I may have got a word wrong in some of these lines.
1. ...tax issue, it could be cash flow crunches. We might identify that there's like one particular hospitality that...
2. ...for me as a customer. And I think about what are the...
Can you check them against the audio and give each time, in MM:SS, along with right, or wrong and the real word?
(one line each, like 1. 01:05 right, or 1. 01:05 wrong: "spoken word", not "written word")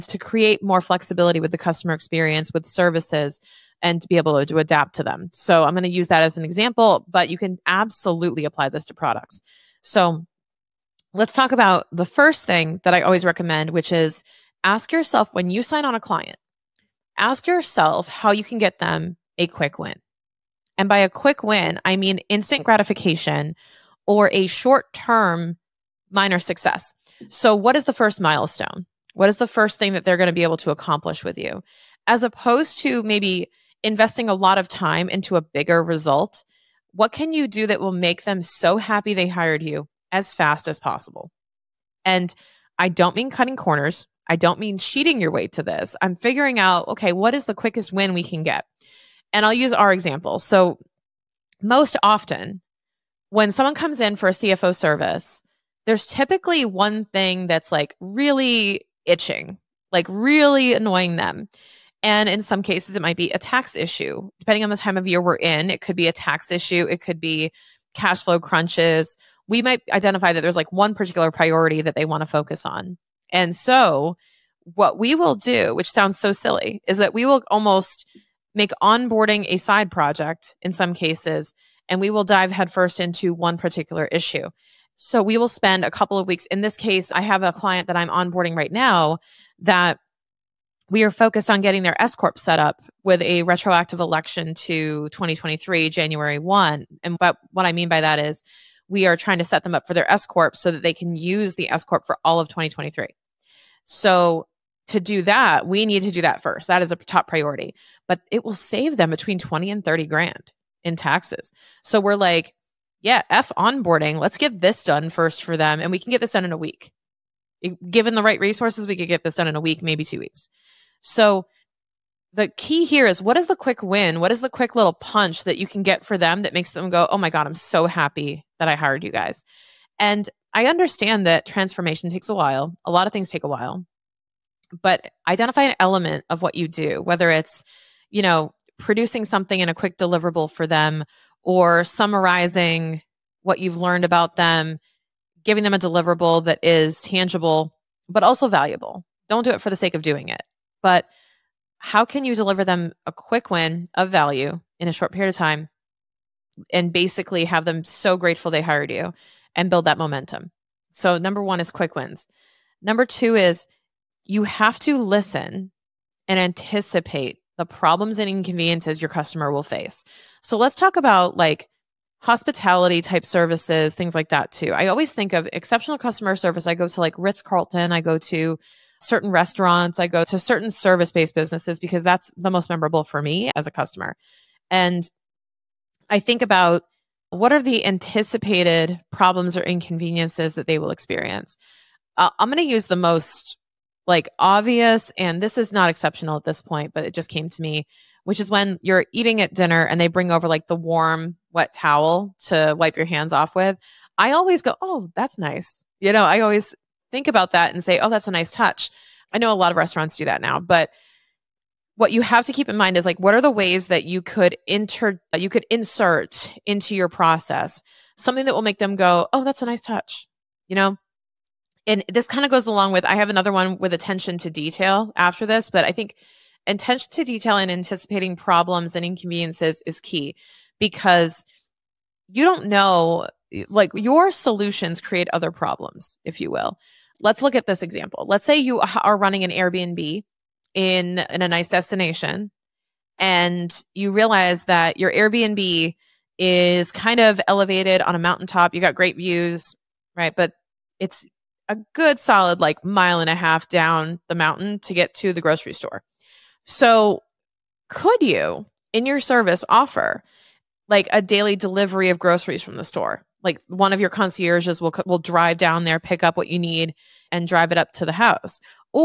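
1. 01:06 wrong: "priority", not "hospitality"
2. 03:03 right.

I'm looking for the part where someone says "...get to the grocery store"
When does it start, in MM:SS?
04:14.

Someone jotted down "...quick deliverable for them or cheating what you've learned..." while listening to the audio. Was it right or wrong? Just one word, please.
wrong.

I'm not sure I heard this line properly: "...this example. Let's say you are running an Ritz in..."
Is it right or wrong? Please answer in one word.
wrong.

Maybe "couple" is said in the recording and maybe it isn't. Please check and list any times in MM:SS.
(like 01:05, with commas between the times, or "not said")
01:25.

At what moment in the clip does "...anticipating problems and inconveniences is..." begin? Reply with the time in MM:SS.
03:47.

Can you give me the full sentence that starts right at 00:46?
I'm figuring out, okay, what is the quickest win we can get?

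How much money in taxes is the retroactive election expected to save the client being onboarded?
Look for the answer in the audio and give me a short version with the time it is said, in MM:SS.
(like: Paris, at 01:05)
20 to 30 grand, at 01:49.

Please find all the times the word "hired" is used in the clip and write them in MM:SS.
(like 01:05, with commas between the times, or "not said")
00:39, 02:08, 02:38.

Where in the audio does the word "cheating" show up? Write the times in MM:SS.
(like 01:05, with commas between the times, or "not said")
00:44.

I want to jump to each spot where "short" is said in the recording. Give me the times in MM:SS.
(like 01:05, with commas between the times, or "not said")
00:24, 02:34.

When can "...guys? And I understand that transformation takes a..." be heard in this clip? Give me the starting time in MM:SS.
02:09.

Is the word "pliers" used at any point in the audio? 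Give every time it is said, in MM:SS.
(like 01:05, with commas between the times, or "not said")
not said.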